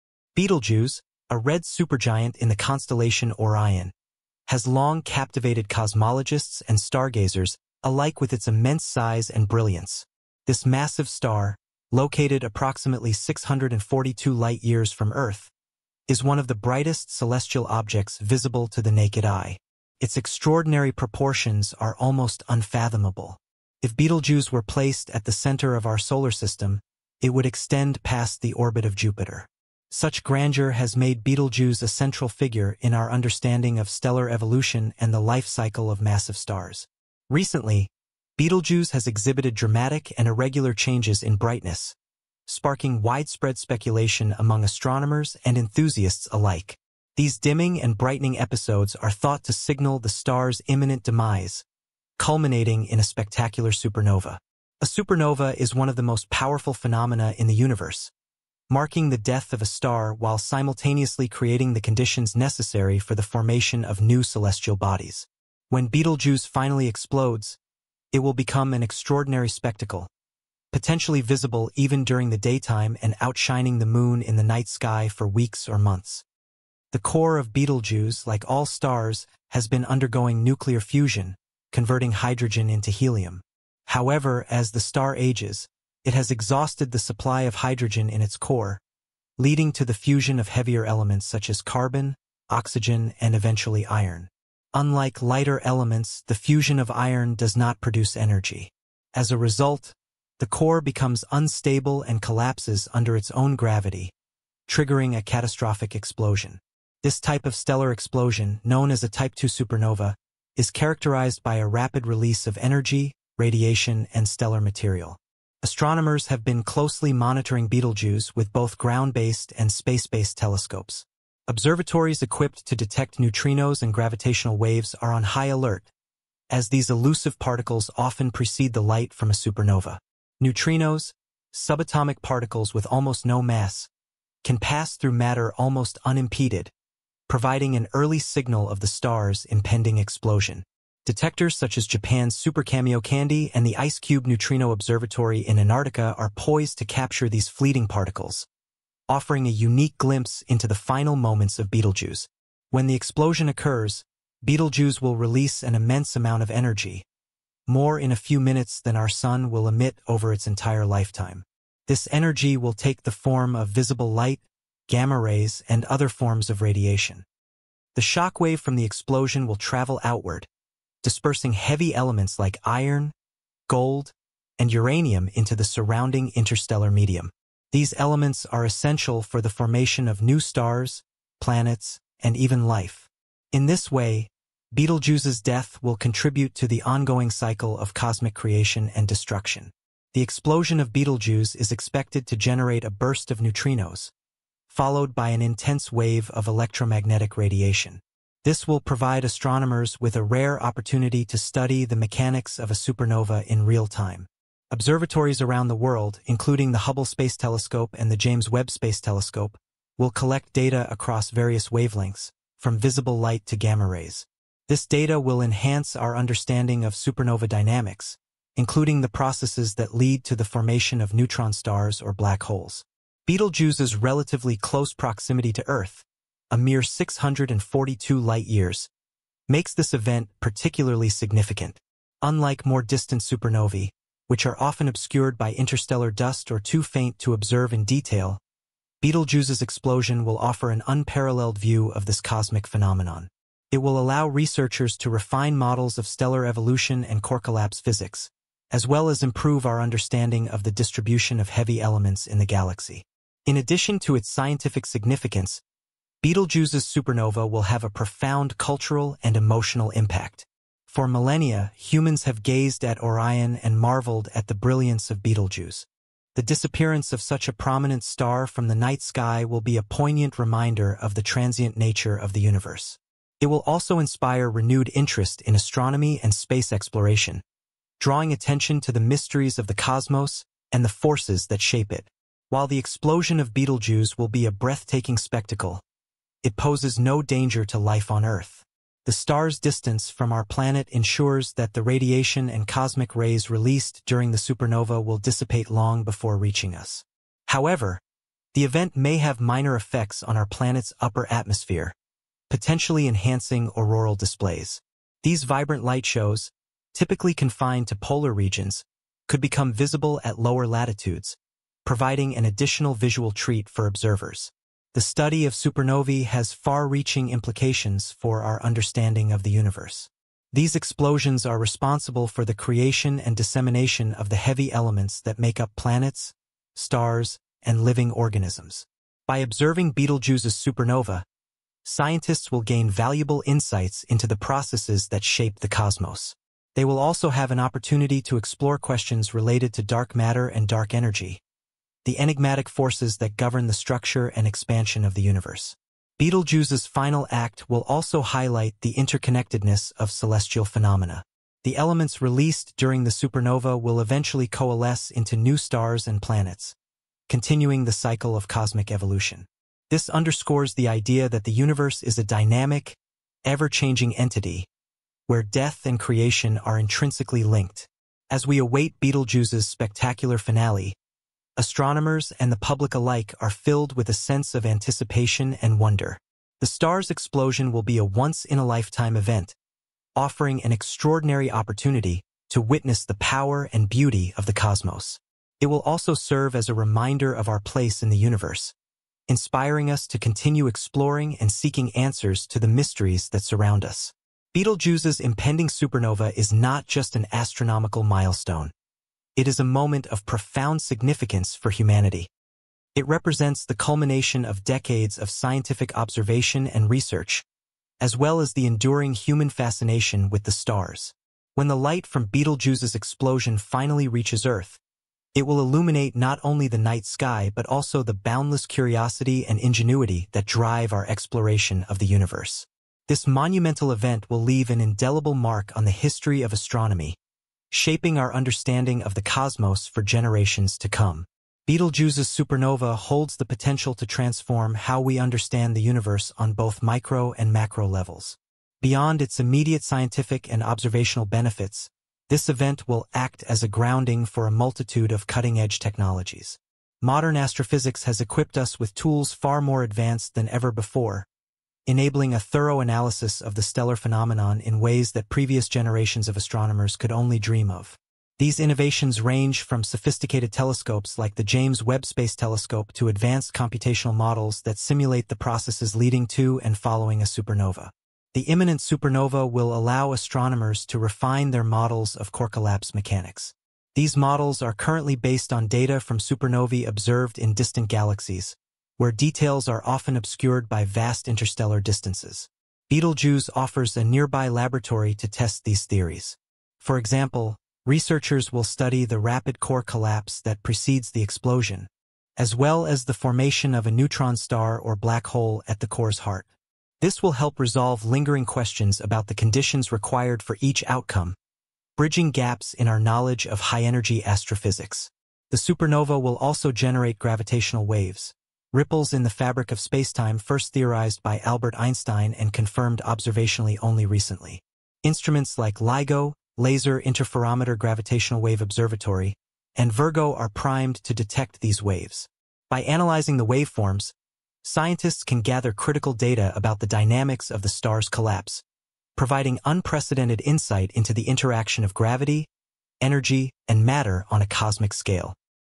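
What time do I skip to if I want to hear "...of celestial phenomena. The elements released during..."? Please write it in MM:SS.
05:49.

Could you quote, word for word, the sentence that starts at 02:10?
Neutrinos, subatomic particles with almost no mass, can pass through matter almost unimpeded, providing an early signal of the star's impending explosion.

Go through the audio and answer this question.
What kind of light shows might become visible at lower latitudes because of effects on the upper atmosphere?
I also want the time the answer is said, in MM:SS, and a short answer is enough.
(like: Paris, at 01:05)
Auroral displays, at 05:03.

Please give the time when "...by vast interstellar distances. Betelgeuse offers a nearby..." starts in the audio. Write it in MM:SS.
08:00.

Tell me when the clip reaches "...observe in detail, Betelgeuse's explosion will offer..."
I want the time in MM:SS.
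03:57.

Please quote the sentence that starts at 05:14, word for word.
The study of supernovae has far-reaching implications for our understanding of the universe.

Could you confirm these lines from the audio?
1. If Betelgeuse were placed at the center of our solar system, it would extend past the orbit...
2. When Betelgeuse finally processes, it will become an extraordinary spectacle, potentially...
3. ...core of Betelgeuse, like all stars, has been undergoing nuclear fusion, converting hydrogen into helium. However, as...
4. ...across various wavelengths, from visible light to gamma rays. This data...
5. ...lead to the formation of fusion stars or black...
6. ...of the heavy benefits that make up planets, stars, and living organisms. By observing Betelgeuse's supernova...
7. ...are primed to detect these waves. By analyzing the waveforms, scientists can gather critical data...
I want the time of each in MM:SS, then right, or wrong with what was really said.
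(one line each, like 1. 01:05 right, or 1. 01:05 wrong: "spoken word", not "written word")
1. 00:23 right
2. 01:05 wrong: "explodes", not "processes"
3. 01:16 right
4. 03:30 right
5. 03:39 wrong: "neutron", not "fusion"
6. 05:24 wrong: "elements", not "benefits"
7. 08:40 right.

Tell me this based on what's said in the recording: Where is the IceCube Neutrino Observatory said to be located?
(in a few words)
Antarctica.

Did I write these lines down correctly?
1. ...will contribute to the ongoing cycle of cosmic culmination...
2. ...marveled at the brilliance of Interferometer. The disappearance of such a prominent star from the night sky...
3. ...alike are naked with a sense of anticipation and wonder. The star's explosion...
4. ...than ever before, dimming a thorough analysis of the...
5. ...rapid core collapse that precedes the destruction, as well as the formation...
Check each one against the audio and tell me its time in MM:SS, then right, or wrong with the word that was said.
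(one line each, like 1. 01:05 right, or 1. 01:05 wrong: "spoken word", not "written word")
1. 03:05 wrong: "creation", not "culmination"
2. 04:23 wrong: "Betelgeuse", not "Interferometer"
3. 06:12 wrong: "filled", not "naked"
4. 07:30 wrong: "enabling", not "dimming"
5. 08:09 wrong: "explosion", not "destruction".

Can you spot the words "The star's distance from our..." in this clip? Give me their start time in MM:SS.
04:49.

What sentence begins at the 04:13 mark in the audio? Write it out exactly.
In addition to its scientific significance, Betelgeuse's supernova will have a profound cultural and emotional impact.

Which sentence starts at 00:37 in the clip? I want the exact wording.
Recently, Betelgeuse has exhibited dramatic and irregular changes in brightness, sparking widespread speculation among astronomers and enthusiasts alike.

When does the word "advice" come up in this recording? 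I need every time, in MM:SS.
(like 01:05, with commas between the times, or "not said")
not said.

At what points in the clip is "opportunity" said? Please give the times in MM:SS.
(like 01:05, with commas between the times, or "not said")
03:20, 05:37, 06:21.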